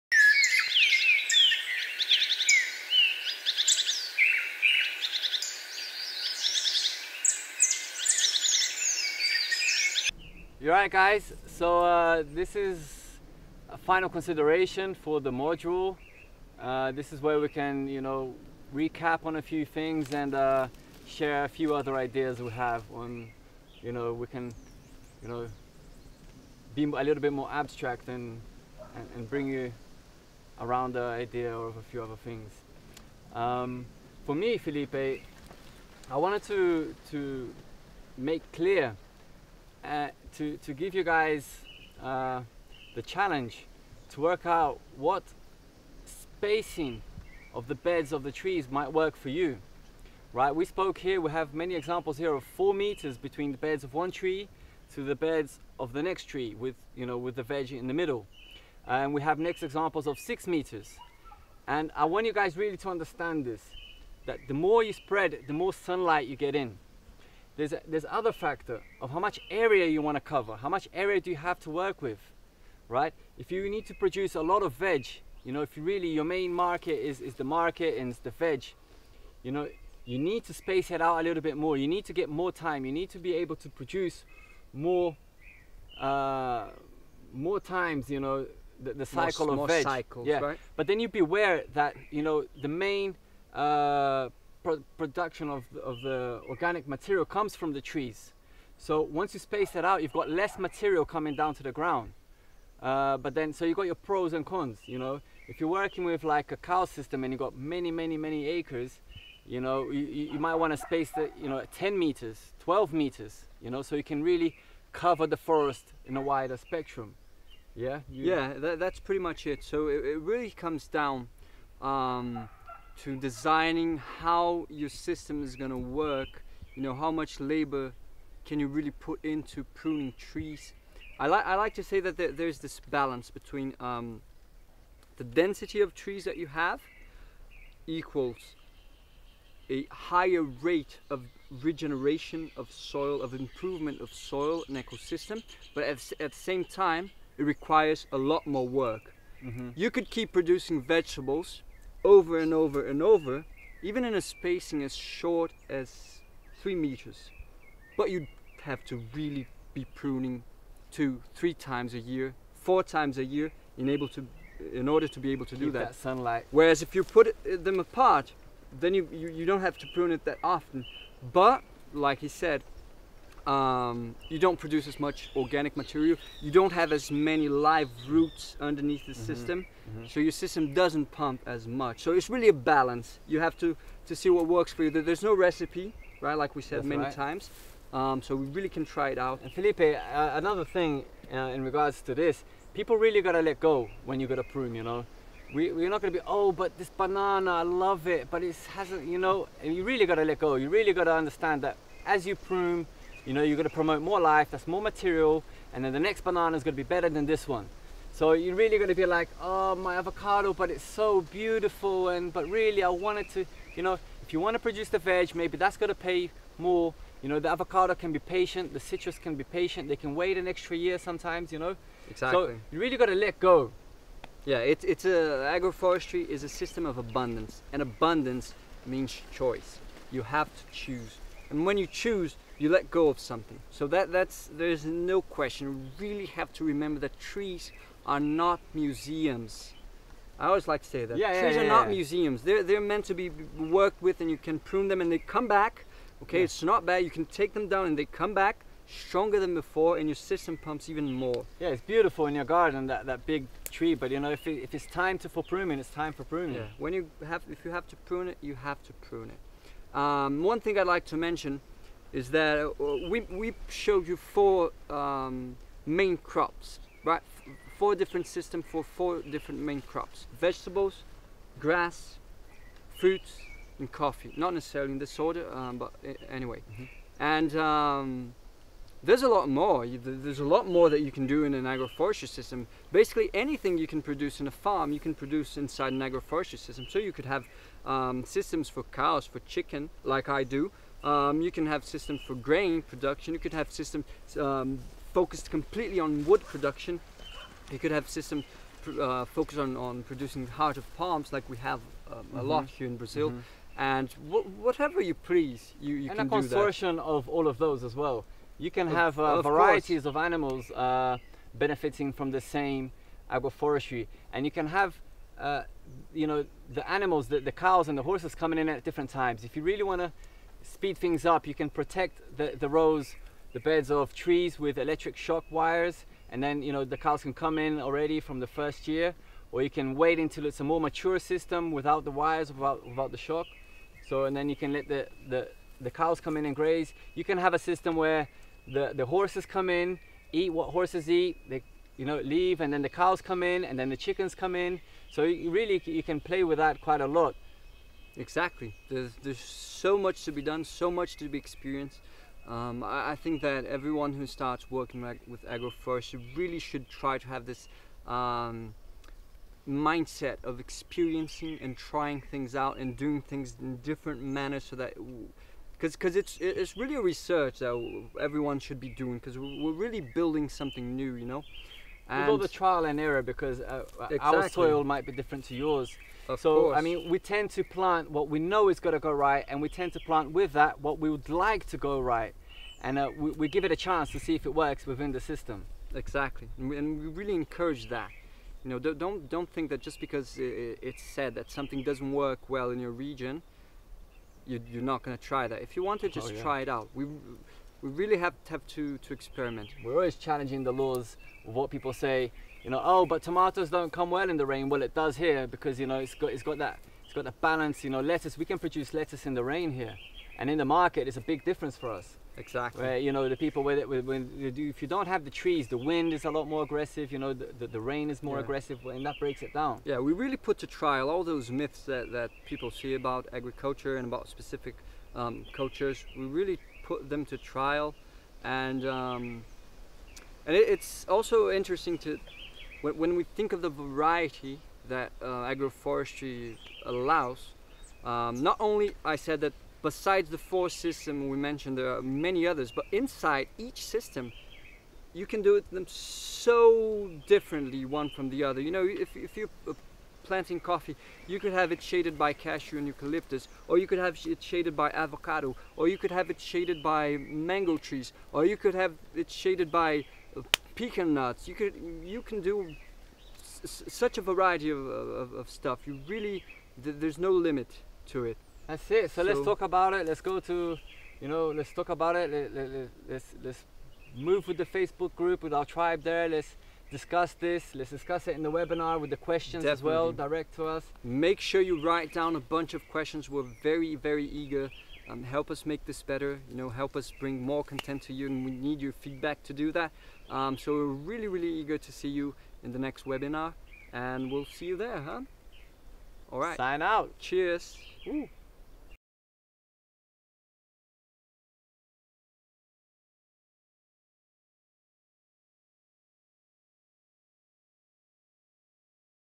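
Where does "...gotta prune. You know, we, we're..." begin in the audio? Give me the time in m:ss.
3:14.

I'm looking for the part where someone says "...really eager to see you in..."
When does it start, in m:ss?
8:11.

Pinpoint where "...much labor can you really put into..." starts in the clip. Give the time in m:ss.
2:07.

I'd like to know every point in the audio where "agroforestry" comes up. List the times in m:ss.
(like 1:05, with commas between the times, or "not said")
3:45, 4:41, 4:46, 5:13, 5:55, 7:15.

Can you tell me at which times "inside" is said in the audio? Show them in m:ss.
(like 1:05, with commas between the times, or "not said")
4:45, 7:22.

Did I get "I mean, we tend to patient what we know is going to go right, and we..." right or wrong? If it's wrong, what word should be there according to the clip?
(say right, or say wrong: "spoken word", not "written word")
wrong: "plant", not "patient".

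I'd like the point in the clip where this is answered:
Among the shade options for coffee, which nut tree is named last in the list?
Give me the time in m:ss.
7:40.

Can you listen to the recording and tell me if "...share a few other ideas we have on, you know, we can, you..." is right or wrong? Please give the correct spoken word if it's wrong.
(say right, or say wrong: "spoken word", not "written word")
right.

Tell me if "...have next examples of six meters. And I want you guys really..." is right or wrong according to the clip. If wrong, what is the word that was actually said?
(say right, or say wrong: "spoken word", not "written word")
right.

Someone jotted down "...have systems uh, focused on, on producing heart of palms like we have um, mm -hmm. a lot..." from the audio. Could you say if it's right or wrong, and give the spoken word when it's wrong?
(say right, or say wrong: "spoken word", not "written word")
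right.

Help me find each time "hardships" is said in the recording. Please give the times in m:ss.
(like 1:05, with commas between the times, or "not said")
not said.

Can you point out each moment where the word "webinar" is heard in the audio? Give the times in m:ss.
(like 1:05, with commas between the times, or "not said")
7:58, 8:13.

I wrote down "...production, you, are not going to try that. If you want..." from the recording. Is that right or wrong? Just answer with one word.
wrong.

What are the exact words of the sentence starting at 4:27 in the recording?
Four different systems for four different main crops.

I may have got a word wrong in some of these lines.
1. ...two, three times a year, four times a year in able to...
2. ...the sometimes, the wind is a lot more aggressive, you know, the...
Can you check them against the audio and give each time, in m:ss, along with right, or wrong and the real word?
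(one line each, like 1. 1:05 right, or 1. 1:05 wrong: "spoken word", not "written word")
1. 2:40 right
2. 6:55 wrong: "trees", not "sometimes".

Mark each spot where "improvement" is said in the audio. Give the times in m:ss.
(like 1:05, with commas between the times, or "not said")
2:23.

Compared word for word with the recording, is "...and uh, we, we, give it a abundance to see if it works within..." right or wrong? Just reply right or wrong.
wrong.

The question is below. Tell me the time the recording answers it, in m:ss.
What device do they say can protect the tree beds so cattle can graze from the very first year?
5:24.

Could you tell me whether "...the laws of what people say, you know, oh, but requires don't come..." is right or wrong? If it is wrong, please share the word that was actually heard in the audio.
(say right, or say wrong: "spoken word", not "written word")
wrong: "tomatoes", not "requires".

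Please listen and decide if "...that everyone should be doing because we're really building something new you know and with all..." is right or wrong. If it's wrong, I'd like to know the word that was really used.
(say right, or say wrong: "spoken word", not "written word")
right.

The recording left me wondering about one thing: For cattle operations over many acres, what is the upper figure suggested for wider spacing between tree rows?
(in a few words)
12 meters.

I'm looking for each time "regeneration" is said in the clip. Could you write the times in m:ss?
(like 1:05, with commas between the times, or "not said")
2:21.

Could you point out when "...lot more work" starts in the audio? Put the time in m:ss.
2:28.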